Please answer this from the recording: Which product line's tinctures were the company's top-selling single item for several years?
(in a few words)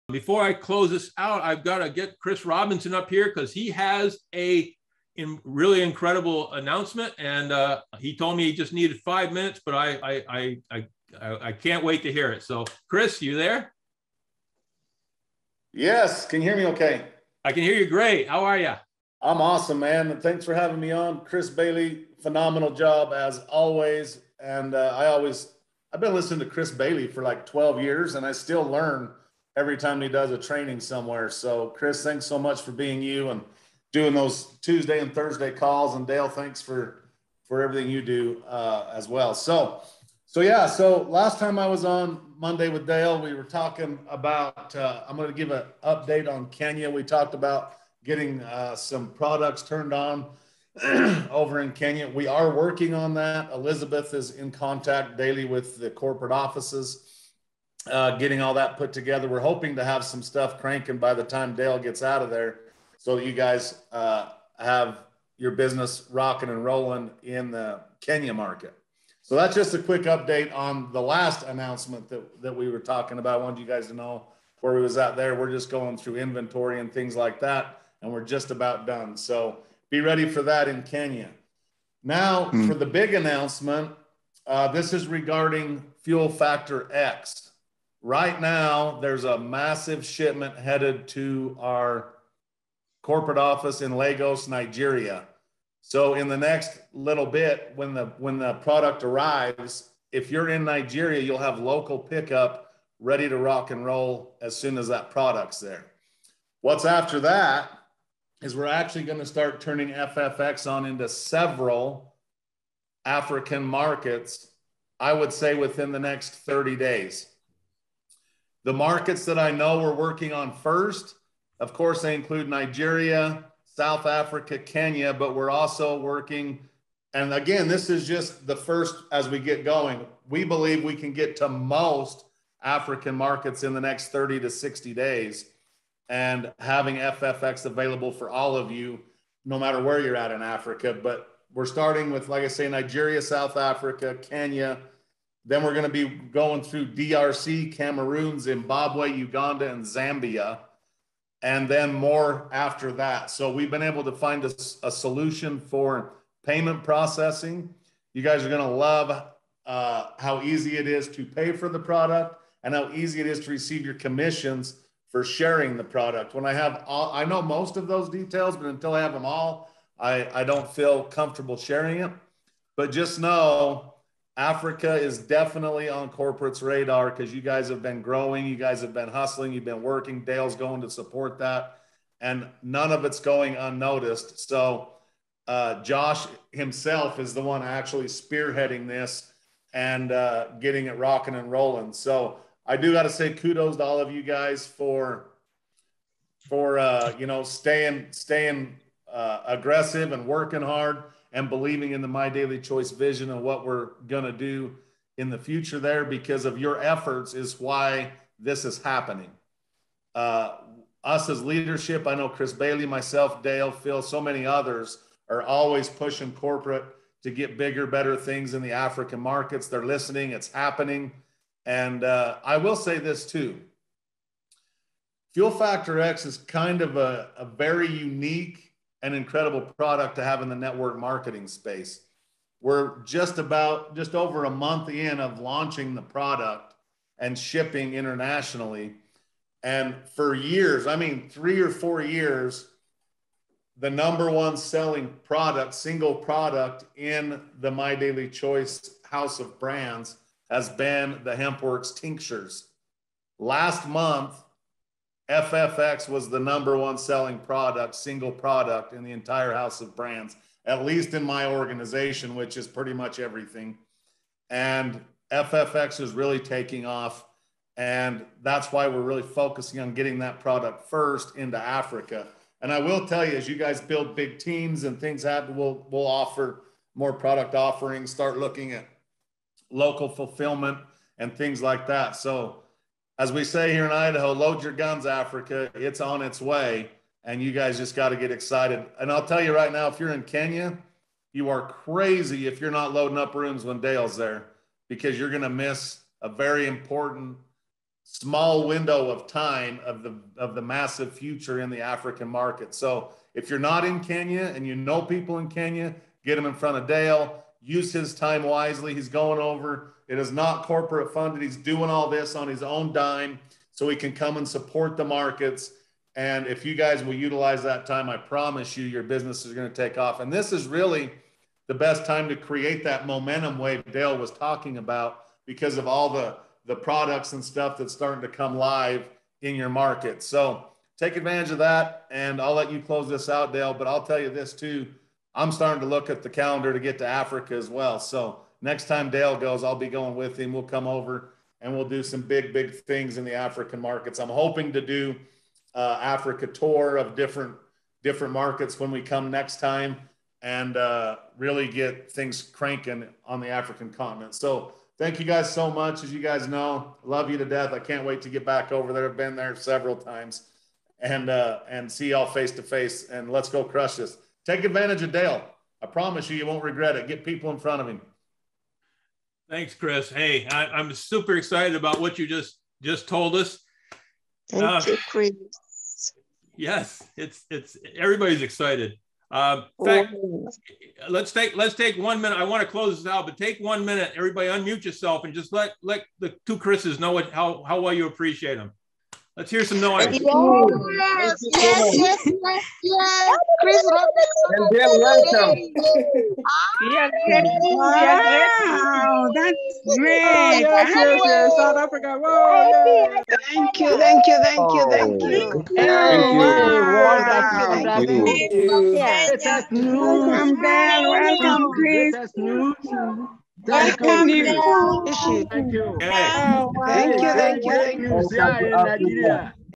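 Hempworx.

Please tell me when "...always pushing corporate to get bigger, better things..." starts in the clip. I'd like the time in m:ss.
3:35.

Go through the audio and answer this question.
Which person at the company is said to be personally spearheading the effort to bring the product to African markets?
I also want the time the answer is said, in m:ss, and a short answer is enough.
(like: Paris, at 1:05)
Josh, at 3:05.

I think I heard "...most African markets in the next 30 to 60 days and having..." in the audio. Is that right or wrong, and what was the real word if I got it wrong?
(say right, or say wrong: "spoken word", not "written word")
right.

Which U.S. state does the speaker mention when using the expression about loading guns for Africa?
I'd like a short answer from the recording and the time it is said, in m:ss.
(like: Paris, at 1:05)
Idaho, at 4:43.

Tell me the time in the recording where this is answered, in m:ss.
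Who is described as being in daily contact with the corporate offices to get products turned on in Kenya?
0:53.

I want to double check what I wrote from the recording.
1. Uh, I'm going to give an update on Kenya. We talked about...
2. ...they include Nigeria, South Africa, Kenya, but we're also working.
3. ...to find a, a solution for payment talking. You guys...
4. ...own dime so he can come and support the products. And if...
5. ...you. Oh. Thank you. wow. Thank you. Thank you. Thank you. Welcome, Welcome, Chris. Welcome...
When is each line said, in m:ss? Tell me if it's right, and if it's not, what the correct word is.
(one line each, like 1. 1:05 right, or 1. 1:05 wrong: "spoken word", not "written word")
1. 0:44 right
2. 2:02 right
3. 2:34 wrong: "processing", not "talking"
4. 5:12 wrong: "markets", not "products"
5. 6:45 right.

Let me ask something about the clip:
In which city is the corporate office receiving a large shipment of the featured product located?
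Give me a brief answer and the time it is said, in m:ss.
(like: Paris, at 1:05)
Lagos, at 1:33.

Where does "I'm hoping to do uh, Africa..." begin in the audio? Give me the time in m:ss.
5:44.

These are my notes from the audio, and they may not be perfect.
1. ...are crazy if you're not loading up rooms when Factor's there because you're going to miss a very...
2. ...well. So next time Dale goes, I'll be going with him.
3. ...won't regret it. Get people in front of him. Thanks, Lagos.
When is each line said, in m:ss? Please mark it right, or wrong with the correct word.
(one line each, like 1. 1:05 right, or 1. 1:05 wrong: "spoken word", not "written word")
1. 4:51 wrong: "Dale", not "Factor"
2. 5:37 right
3. 6:06 wrong: "Chris", not "Lagos".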